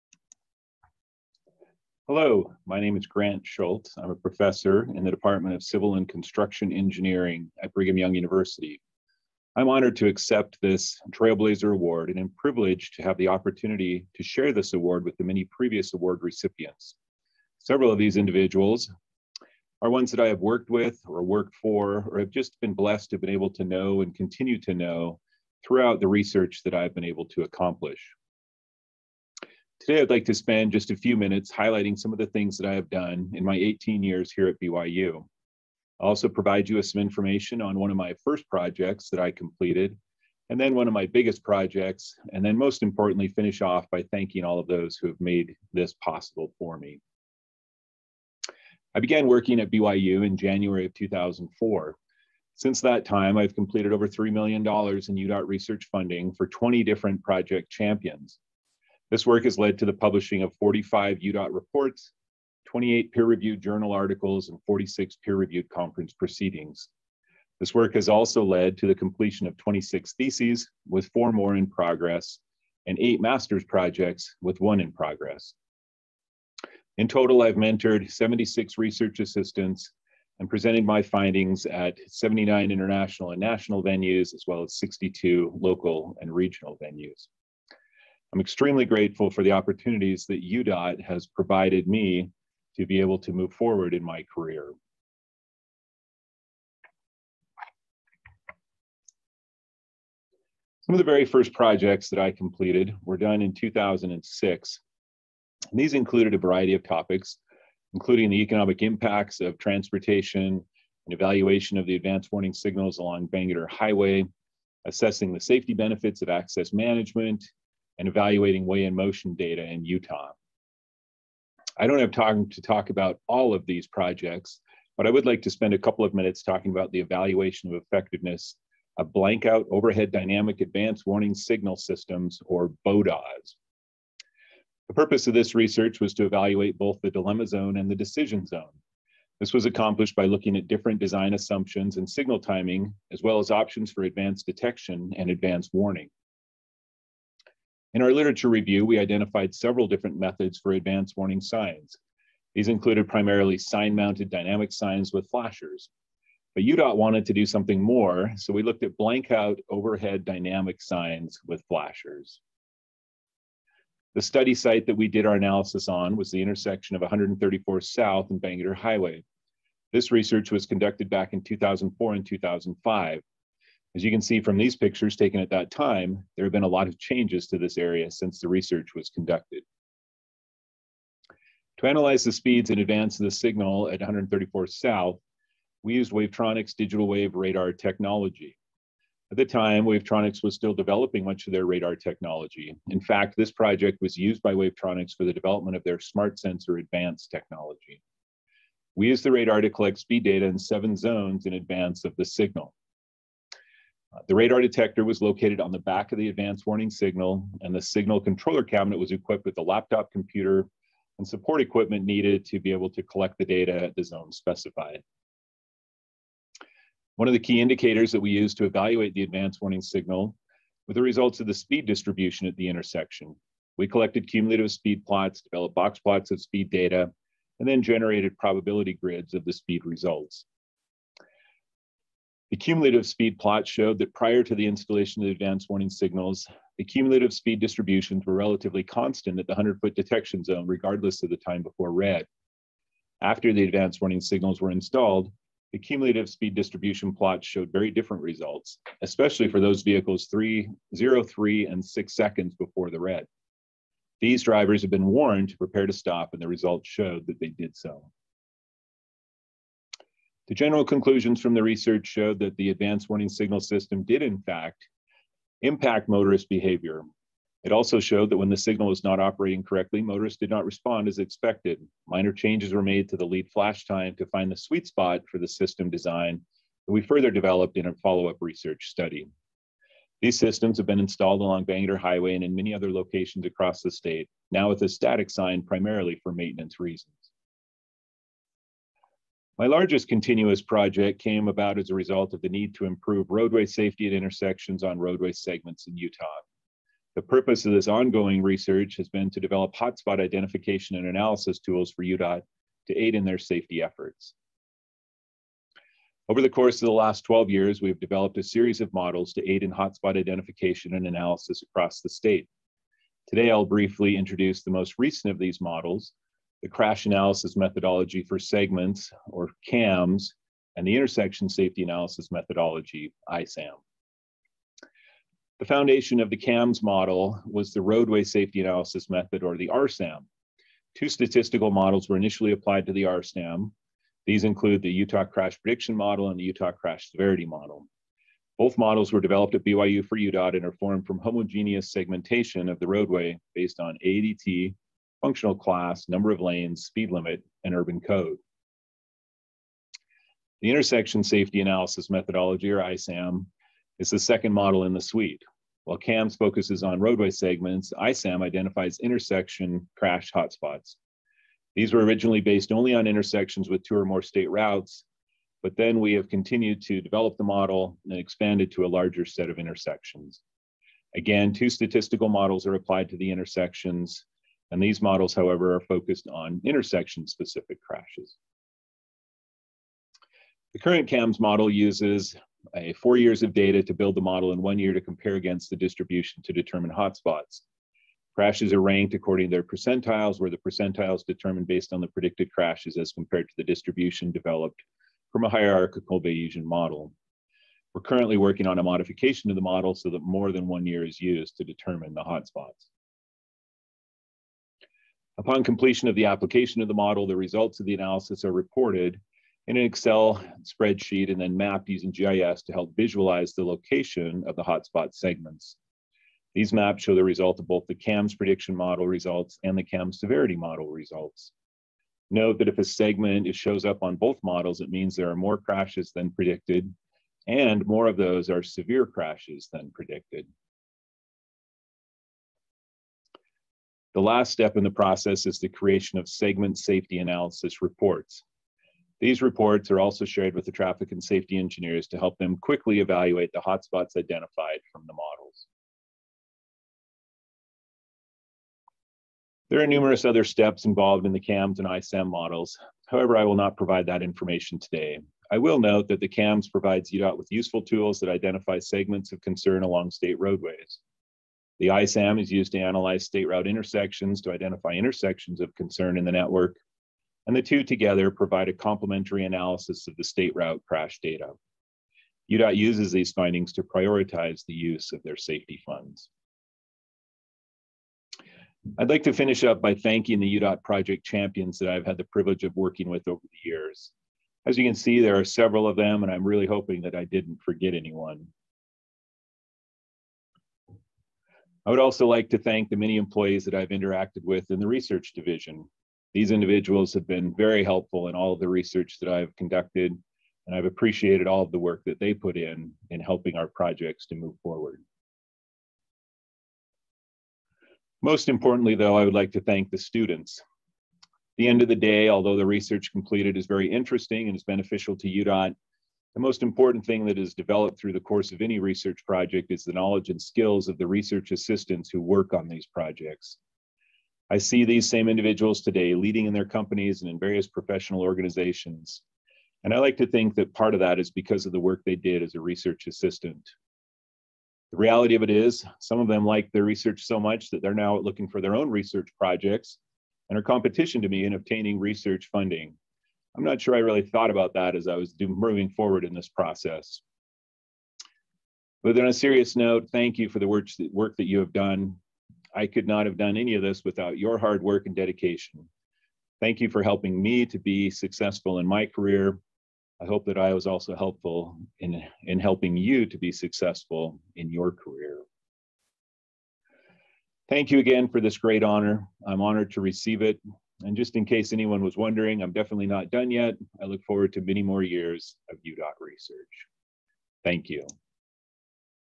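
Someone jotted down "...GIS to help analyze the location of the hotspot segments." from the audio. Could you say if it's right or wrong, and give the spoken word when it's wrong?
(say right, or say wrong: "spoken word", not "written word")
wrong: "visualize", not "analyze".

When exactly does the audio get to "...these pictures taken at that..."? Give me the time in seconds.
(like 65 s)
174 s.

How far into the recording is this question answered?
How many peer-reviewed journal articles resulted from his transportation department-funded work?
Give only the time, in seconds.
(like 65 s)
62 s.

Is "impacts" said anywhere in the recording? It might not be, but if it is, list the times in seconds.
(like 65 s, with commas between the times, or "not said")
108 s, 265 s.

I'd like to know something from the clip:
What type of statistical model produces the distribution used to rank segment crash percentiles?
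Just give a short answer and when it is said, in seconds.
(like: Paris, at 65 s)
hierarchical Bayesian model, at 395 s.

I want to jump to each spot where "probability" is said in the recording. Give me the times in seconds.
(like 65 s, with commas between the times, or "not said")
228 s.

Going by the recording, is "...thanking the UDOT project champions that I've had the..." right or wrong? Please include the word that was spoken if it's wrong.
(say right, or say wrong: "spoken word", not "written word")
right.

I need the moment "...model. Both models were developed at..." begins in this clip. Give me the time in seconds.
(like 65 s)
337 s.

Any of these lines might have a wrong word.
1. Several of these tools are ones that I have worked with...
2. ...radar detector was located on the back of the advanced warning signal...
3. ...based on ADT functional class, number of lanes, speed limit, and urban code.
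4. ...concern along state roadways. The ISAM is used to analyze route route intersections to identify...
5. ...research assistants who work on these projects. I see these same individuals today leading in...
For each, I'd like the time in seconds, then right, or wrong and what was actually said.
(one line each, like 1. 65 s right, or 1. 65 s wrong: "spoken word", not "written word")
1. 17 s wrong: "individuals", not "tools"
2. 204 s right
3. 343 s right
4. 459 s wrong: "state", not "route"
5. 521 s right.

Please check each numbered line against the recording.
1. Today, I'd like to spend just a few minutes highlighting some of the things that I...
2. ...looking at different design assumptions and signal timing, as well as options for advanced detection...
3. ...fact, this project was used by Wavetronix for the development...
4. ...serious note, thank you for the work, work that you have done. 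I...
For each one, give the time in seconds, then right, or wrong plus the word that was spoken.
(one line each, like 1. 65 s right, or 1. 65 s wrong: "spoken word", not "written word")
1. 29 s right
2. 140 s right
3. 193 s right
4. 549 s right.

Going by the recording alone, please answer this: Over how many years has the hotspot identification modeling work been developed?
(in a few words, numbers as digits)
12.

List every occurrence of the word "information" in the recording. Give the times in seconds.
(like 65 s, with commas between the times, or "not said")
37 s, 454 s.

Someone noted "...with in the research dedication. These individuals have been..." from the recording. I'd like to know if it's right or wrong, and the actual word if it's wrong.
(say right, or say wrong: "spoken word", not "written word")
wrong: "division", not "dedication".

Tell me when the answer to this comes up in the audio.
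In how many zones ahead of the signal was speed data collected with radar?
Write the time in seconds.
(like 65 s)
200 s.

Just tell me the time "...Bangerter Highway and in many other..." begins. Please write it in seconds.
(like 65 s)
281 s.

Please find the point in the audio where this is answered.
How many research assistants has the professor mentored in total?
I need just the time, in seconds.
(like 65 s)
78 s.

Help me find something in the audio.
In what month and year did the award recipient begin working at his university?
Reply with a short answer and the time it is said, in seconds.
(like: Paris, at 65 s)
January 2004, at 50 s.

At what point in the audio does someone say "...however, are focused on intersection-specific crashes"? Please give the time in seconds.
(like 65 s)
375 s.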